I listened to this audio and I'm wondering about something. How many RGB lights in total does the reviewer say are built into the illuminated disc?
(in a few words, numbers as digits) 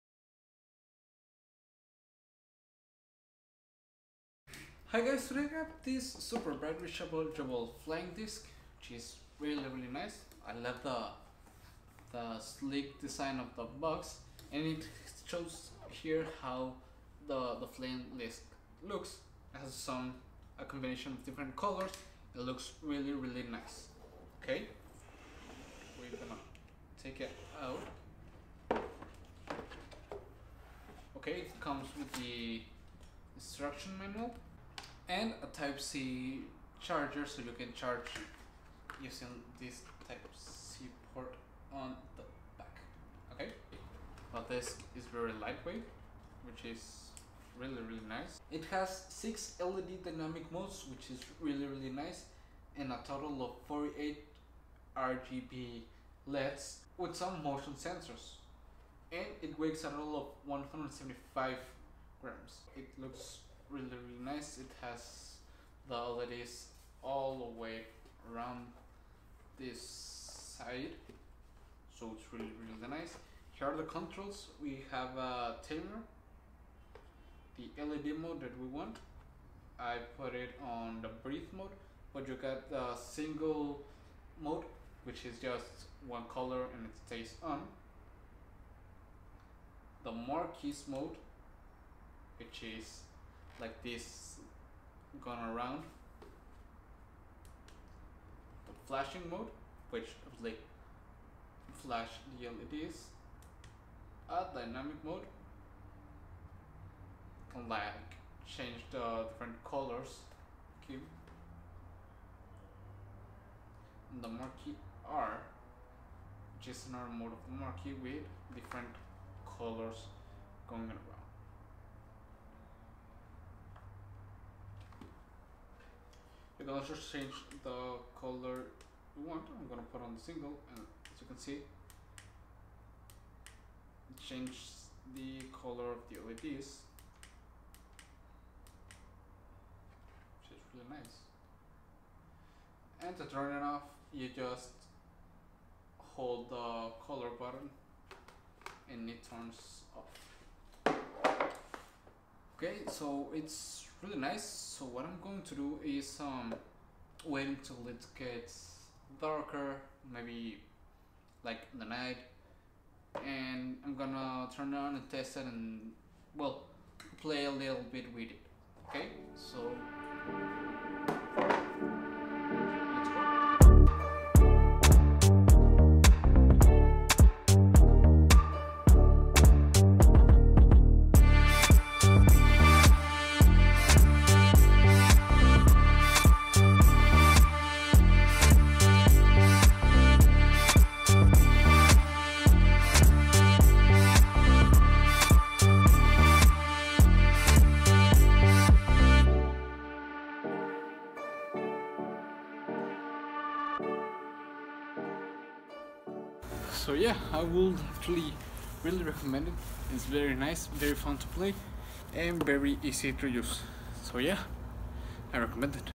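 48.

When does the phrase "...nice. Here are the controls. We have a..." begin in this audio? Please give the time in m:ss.
1:12.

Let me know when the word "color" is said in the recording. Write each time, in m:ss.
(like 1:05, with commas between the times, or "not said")
0:21, 1:26, 1:49, 1:59, 2:08, 2:15, 2:27.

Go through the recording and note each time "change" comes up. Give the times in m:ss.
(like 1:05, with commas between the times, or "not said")
1:48, 2:06, 2:14.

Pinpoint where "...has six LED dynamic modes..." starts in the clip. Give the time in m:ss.
0:48.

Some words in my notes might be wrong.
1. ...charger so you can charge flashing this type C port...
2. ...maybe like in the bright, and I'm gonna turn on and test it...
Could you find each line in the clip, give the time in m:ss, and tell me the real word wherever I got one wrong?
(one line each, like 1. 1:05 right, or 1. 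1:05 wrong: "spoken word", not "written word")
1. 0:36 wrong: "using", not "flashing"
2. 2:40 wrong: "night", not "bright".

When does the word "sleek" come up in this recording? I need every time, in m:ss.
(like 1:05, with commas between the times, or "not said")
0:12.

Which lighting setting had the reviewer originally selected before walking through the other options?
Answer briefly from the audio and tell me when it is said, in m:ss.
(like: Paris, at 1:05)
Breathe mode, at 1:21.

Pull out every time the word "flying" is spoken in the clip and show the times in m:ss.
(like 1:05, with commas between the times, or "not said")
0:07, 0:17.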